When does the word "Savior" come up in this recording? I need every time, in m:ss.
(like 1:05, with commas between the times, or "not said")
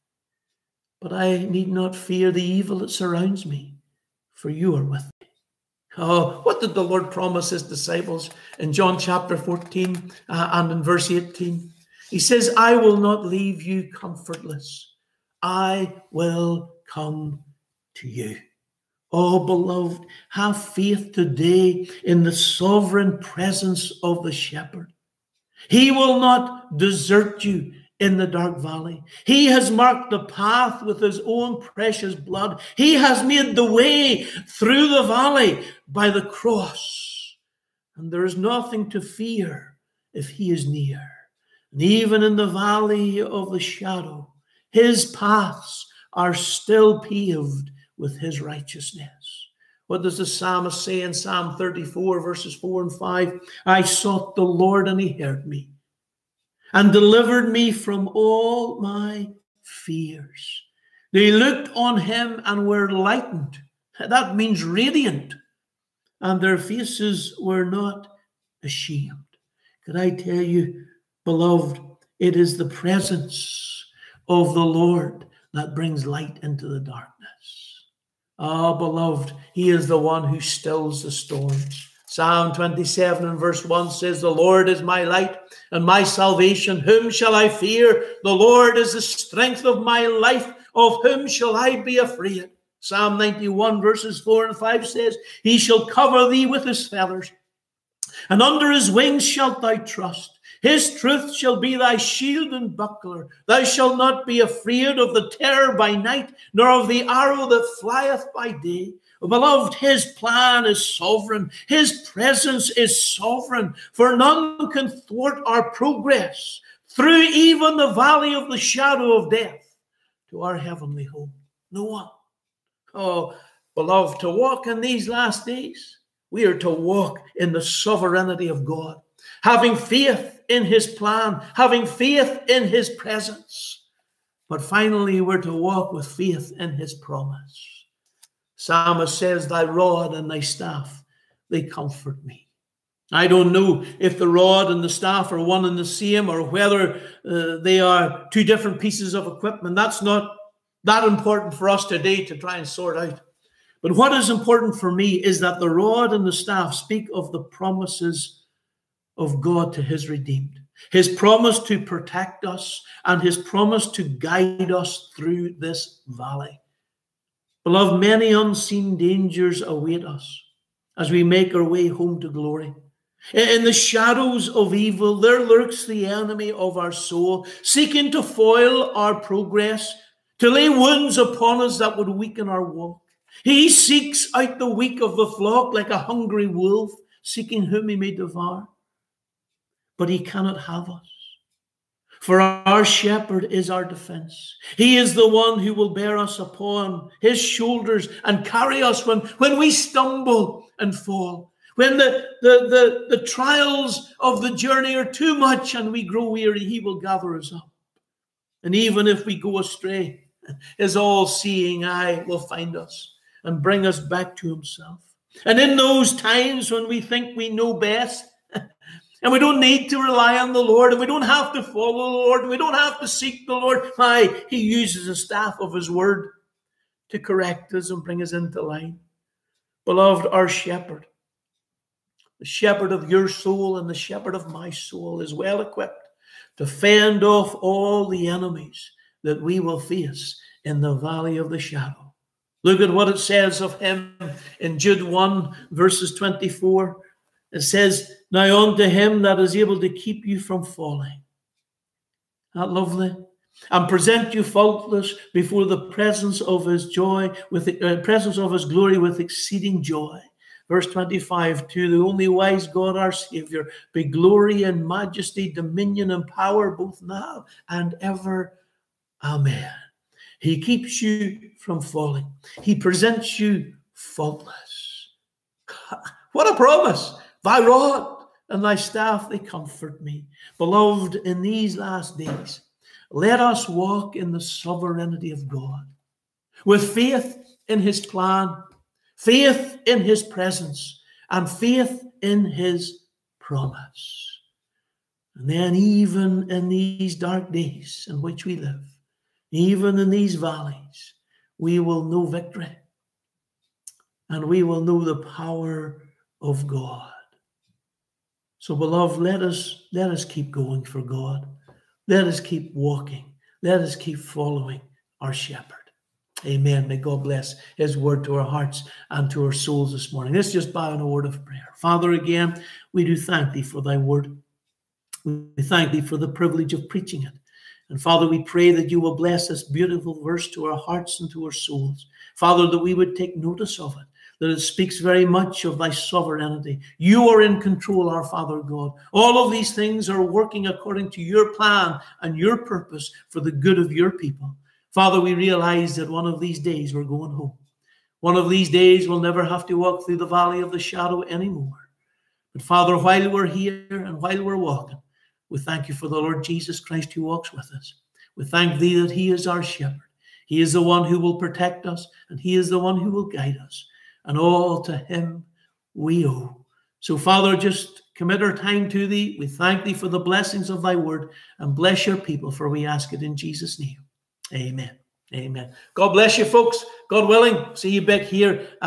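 4:23.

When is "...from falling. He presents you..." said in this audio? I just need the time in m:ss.
4:31.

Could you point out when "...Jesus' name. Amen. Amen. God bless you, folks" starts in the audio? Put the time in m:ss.
6:13.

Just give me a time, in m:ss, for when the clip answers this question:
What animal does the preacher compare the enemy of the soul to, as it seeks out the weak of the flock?
3:05.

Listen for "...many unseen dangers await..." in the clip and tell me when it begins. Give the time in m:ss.
2:47.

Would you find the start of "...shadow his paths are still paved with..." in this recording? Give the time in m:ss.
0:43.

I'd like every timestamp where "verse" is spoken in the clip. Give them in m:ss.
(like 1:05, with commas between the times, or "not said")
0:10, 0:52, 1:23, 1:33, 4:05, 4:20, 5:30.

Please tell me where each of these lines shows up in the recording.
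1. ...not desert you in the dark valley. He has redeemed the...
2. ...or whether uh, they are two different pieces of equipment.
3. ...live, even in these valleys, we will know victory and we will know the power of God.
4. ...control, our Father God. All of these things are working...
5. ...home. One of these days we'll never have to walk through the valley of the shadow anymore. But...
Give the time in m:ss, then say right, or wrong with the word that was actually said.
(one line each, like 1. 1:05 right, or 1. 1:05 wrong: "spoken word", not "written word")
1. 0:26 wrong: "marked", not "redeemed"
2. 2:26 right
3. 4:58 right
4. 5:37 right
5. 5:47 right.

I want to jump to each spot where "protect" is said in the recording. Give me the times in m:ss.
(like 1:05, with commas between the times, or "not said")
2:41, 6:01.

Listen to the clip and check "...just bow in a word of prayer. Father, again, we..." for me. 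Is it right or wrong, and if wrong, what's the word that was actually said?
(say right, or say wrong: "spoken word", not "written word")
right.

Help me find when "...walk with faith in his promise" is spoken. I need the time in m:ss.
2:15.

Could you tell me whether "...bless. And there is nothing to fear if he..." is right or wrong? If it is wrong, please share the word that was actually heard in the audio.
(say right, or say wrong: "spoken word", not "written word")
wrong: "cross", not "bless".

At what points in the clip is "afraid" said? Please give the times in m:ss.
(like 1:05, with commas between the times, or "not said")
1:31, 1:44.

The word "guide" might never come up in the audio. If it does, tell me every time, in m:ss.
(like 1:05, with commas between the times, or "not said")
2:44, 6:03.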